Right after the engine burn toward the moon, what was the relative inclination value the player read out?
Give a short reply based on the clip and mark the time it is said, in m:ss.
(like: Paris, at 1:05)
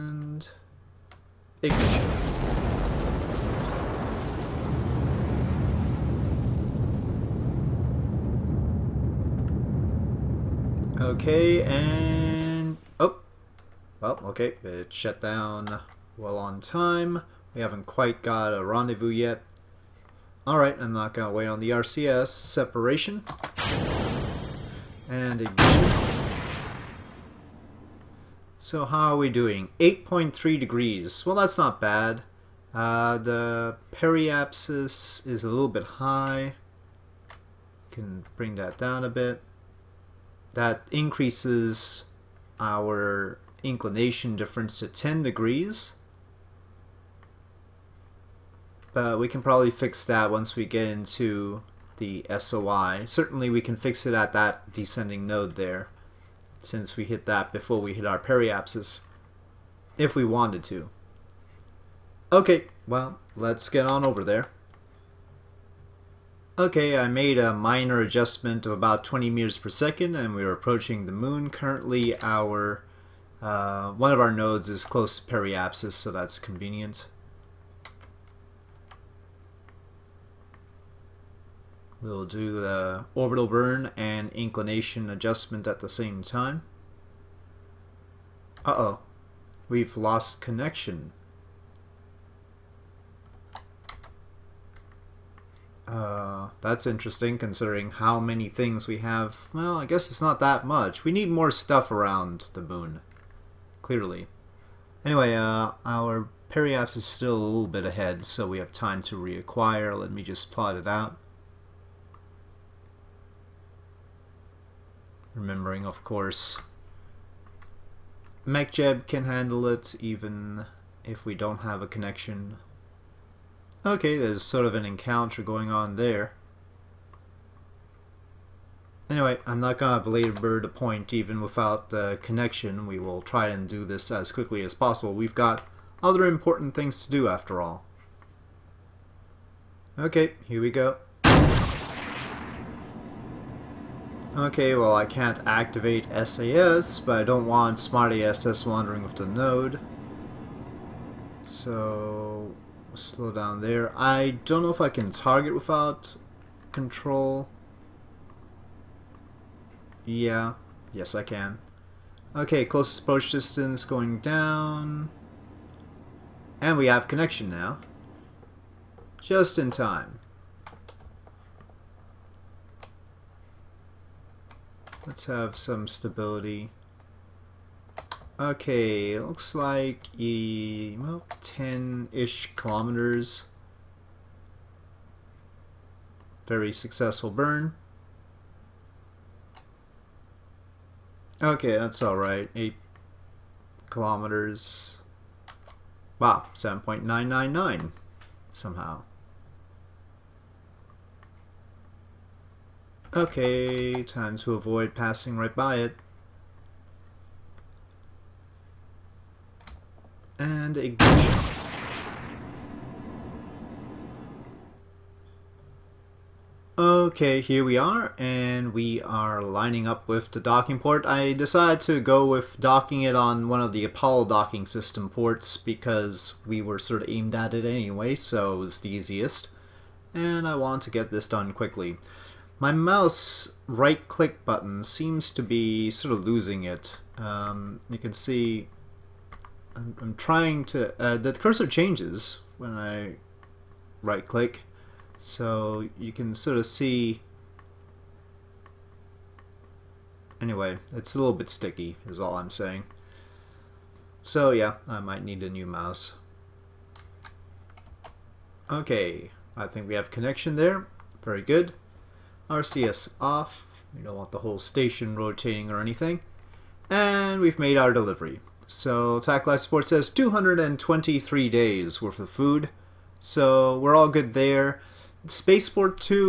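8.3 degrees, at 0:29.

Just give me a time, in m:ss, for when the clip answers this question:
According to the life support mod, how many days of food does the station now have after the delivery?
4:30.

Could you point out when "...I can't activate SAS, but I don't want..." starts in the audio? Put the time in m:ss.
2:24.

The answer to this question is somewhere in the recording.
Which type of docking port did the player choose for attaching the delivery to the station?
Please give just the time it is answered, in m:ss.
3:43.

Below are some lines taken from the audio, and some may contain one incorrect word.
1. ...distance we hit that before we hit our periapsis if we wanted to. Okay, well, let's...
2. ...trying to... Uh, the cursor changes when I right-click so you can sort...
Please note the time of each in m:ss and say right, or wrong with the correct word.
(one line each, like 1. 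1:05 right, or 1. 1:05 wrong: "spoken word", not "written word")
1. 0:56 wrong: "since", not "distance"
2. 4:00 right.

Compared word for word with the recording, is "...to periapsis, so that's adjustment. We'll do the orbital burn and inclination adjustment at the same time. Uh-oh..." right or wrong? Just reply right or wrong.
wrong.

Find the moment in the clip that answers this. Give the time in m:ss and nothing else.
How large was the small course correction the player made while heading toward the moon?
1:09.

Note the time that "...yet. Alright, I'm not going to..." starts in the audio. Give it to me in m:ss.
0:19.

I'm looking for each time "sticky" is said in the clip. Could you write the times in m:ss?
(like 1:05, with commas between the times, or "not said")
4:11.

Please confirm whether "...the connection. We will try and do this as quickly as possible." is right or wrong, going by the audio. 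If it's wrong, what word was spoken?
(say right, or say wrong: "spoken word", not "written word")
right.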